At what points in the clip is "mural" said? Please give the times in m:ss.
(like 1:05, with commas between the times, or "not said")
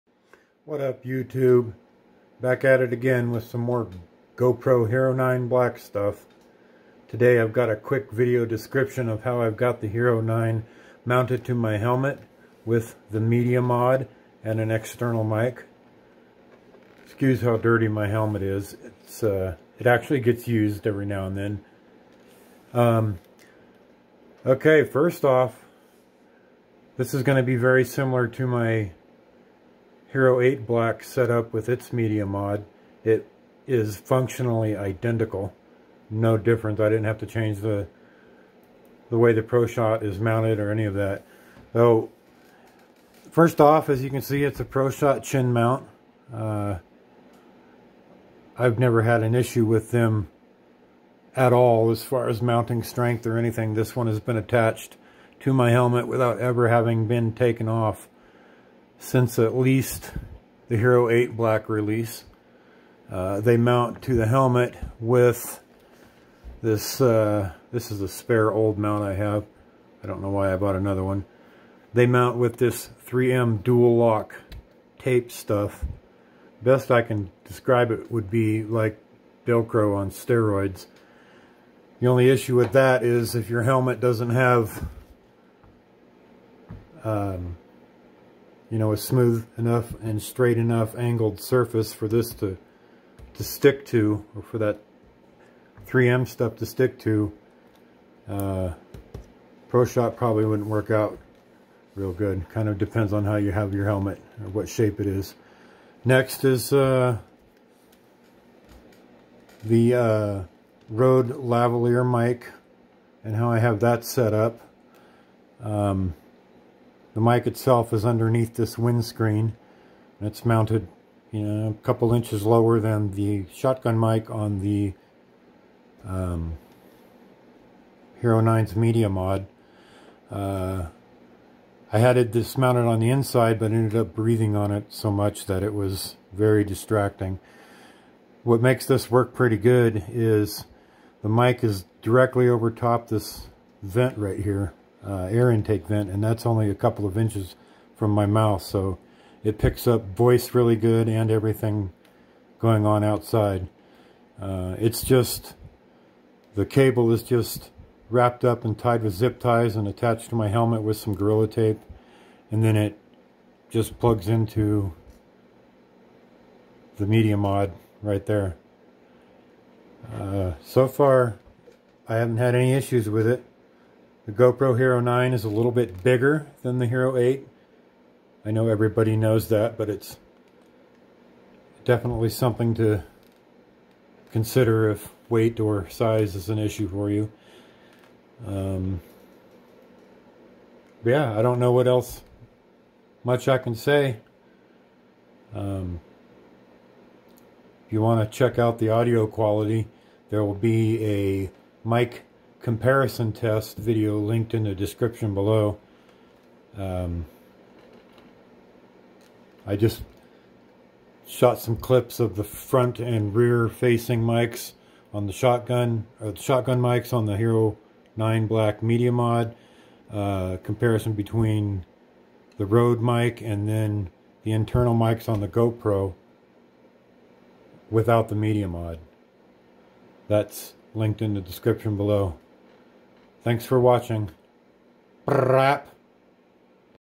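not said.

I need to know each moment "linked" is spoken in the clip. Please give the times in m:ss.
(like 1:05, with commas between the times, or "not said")
3:24, 3:50.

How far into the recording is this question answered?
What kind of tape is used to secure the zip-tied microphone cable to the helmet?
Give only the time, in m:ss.
2:41.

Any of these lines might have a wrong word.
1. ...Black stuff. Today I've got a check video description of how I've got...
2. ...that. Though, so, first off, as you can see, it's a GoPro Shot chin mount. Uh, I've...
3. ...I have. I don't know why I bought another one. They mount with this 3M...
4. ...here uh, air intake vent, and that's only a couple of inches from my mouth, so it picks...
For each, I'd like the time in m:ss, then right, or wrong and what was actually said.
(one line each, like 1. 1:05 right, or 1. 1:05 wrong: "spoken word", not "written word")
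1. 0:05 wrong: "quick", not "check"
2. 0:40 wrong: "Pro", not "GoPro"
3. 1:09 right
4. 2:24 right.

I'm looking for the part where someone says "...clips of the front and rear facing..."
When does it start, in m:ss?
3:31.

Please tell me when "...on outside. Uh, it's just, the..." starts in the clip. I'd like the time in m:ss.
2:32.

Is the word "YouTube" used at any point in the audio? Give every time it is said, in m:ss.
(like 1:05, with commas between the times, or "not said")
0:01.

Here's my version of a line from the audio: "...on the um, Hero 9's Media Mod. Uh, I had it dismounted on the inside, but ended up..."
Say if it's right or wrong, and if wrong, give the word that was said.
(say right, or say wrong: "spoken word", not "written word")
right.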